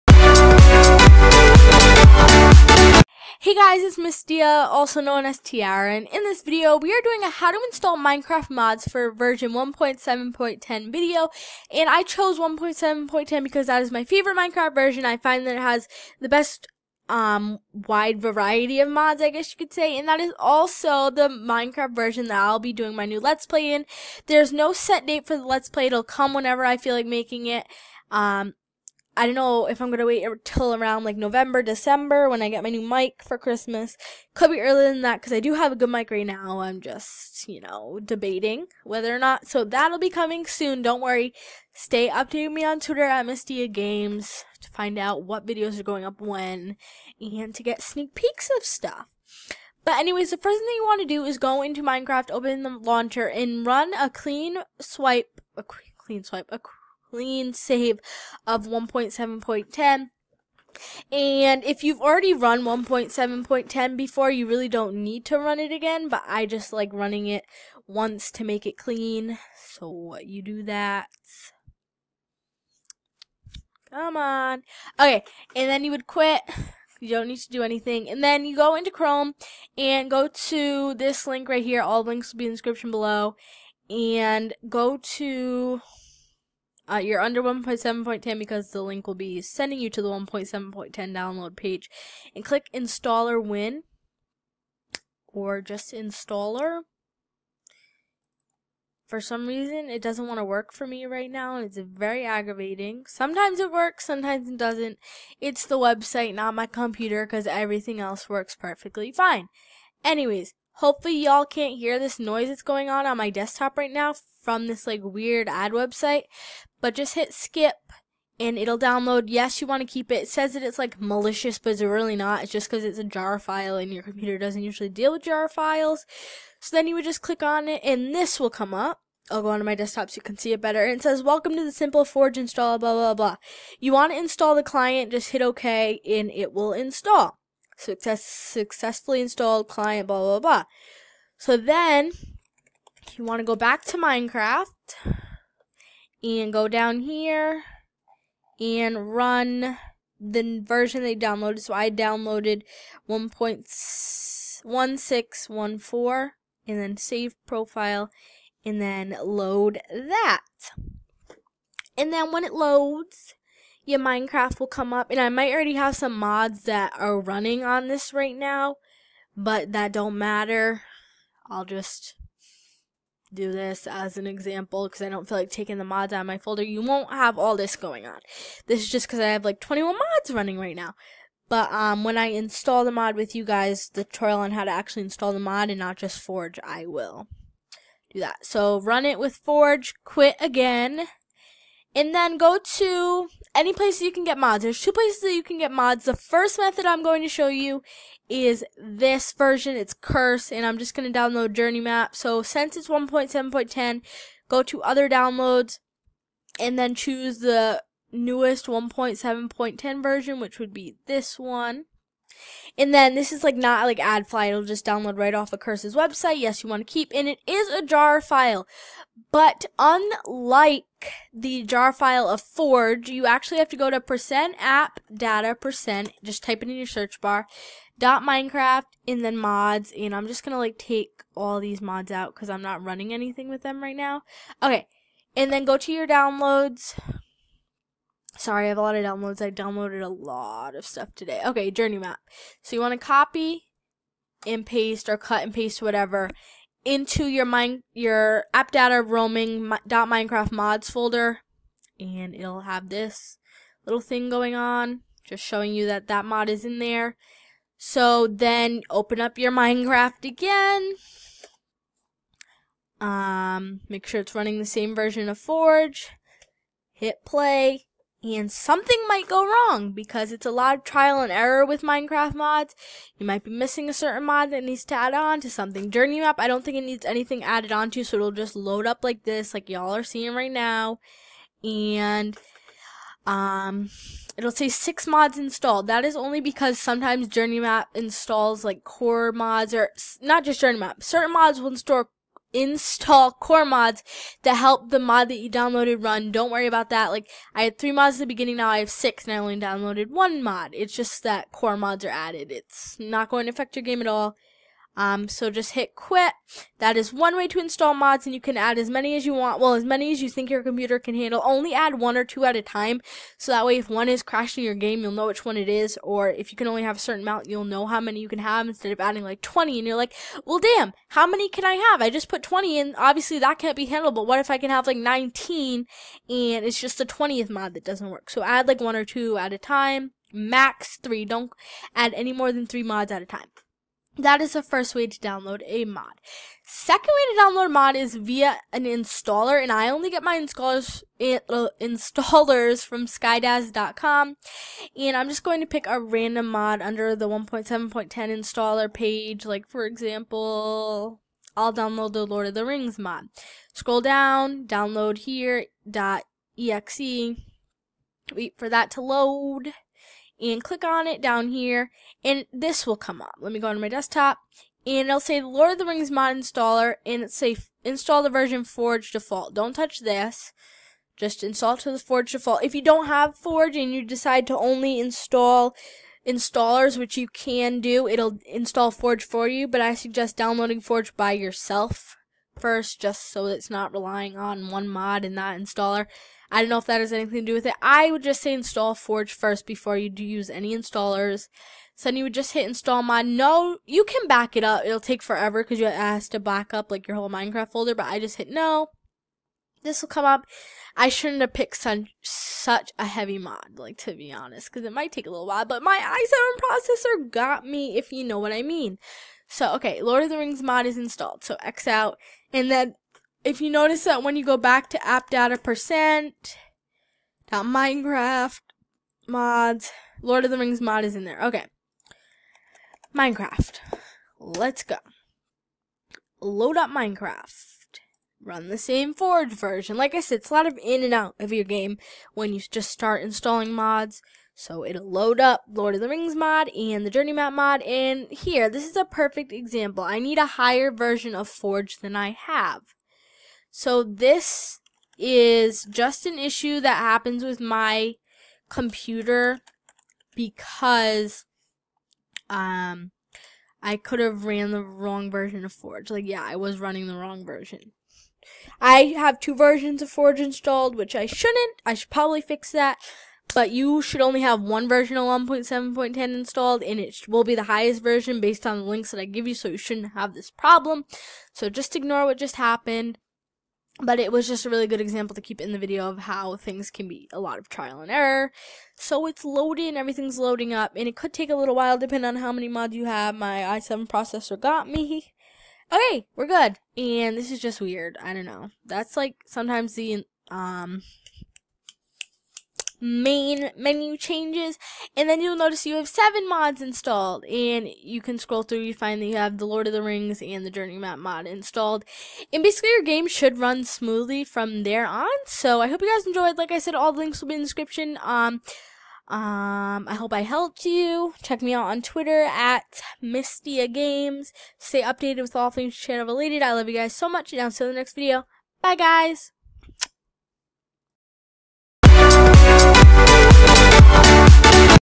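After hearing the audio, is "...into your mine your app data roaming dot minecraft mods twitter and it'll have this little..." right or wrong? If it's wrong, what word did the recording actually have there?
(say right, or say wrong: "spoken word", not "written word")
wrong: "folder", not "twitter".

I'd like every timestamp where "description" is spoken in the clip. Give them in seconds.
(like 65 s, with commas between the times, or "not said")
82 s, 507 s.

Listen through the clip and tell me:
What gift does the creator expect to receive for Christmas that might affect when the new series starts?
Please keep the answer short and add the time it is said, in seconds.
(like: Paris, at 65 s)
new mic, at 32 s.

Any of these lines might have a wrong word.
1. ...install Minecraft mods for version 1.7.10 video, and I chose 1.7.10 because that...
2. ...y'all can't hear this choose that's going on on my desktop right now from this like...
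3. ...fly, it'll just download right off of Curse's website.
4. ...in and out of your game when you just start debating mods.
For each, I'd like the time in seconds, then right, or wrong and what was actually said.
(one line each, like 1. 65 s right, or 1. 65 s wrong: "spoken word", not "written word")
1. 7 s right
2. 111 s wrong: "noise", not "choose"
3. 214 s right
4. 430 s wrong: "installing", not "debating".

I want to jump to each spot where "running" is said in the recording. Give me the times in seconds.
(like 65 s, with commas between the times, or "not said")
66 s, 167 s, 180 s, 232 s, 264 s, 456 s.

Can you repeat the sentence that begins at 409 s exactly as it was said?
So, okay, Lord of the Rings mod is installed.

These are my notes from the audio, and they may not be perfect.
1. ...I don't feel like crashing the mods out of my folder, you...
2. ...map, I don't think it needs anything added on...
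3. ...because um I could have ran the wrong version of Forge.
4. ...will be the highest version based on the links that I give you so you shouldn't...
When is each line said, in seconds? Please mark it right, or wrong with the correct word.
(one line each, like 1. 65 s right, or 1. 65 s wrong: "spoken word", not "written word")
1. 175 s wrong: "taking", not "crashing"
2. 276 s right
3. 450 s right
4. 467 s right.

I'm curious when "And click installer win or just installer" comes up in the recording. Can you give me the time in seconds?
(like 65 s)
92 s.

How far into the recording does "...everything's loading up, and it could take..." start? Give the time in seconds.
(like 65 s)
479 s.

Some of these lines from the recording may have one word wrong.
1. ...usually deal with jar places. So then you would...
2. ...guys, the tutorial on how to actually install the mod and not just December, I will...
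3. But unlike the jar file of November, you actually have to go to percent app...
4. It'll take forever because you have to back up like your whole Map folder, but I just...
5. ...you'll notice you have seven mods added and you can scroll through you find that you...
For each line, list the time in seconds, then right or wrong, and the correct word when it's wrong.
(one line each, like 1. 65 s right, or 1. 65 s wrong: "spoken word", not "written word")
1. 124 s wrong: "files", not "places"
2. 183 s wrong: "Forge", not "December"
3. 219 s wrong: "Forge", not "November"
4. 394 s wrong: "Minecraft", not "Map"
5. 495 s wrong: "installed", not "added".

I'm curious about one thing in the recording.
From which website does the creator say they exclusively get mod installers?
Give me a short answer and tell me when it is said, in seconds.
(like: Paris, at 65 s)
skydaz.com, at 343 s.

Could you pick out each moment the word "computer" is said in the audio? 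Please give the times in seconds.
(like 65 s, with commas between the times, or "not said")
106 s, 124 s, 310 s, 448 s.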